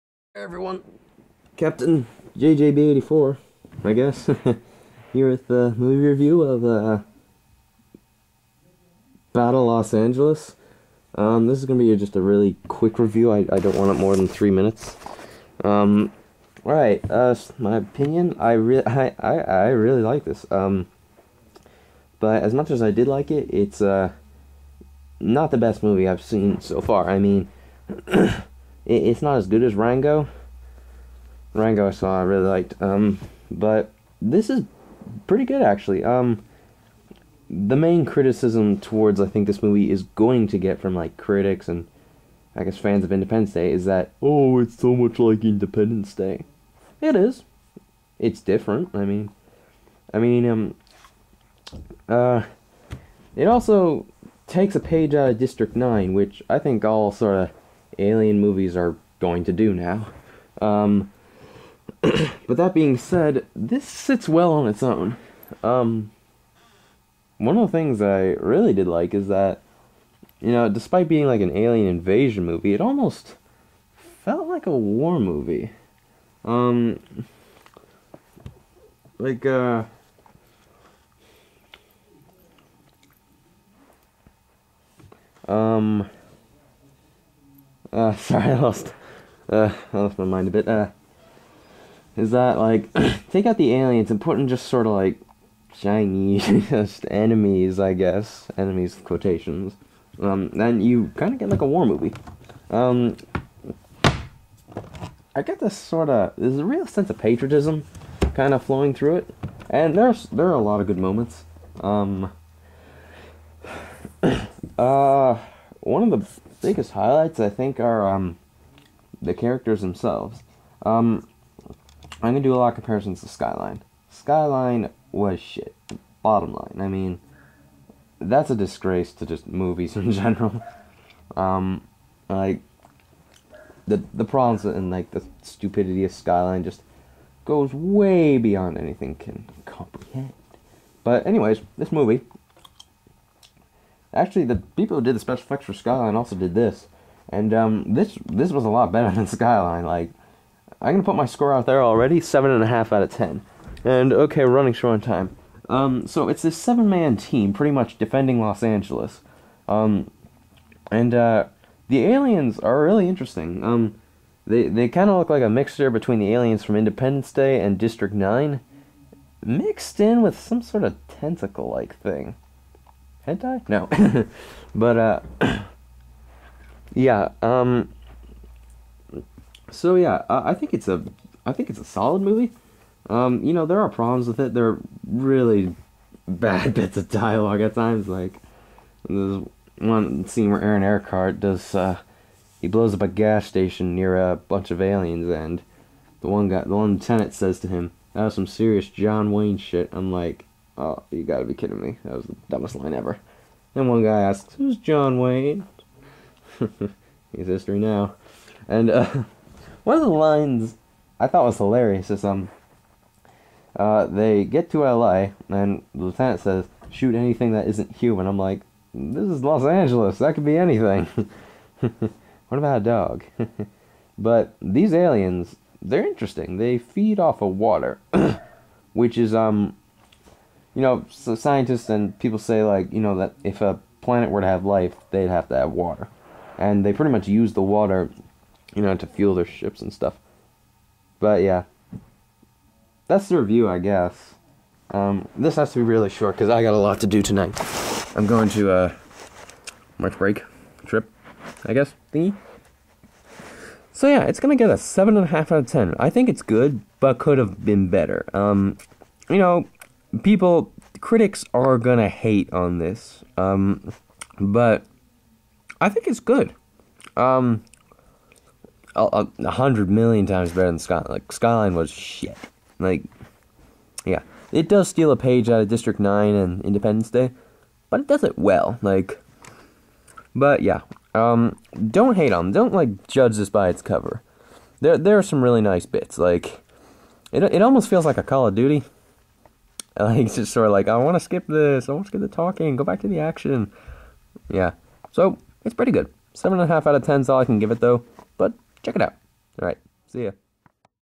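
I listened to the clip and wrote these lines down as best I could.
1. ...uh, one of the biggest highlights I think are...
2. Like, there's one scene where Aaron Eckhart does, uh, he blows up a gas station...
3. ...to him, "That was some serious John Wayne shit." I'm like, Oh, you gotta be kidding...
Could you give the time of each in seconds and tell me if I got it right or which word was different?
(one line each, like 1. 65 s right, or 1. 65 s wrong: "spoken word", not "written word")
1. 114 s right
2. 188 s right
3. 197 s right.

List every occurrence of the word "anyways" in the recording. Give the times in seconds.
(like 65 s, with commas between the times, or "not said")
141 s.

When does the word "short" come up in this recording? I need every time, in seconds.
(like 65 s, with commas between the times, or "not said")
154 s, 246 s.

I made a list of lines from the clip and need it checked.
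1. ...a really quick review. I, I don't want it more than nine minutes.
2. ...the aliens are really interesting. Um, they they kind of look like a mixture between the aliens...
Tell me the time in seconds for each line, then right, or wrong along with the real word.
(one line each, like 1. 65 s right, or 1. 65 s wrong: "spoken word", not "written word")
1. 12 s wrong: "three", not "nine"
2. 161 s right.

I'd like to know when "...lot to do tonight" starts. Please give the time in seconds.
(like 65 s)
246 s.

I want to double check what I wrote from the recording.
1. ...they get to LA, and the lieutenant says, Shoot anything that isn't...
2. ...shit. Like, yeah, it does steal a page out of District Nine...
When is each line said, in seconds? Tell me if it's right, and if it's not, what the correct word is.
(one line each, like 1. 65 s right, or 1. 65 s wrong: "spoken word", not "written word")
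1. 214 s right
2. 271 s right.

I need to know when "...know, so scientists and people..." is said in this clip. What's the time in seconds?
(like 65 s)
230 s.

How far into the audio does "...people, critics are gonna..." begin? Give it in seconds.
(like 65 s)
260 s.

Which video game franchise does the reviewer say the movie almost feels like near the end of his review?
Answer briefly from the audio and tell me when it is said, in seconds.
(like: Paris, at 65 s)
Call of Duty, at 288 s.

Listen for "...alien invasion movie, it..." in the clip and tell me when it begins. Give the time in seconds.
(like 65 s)
71 s.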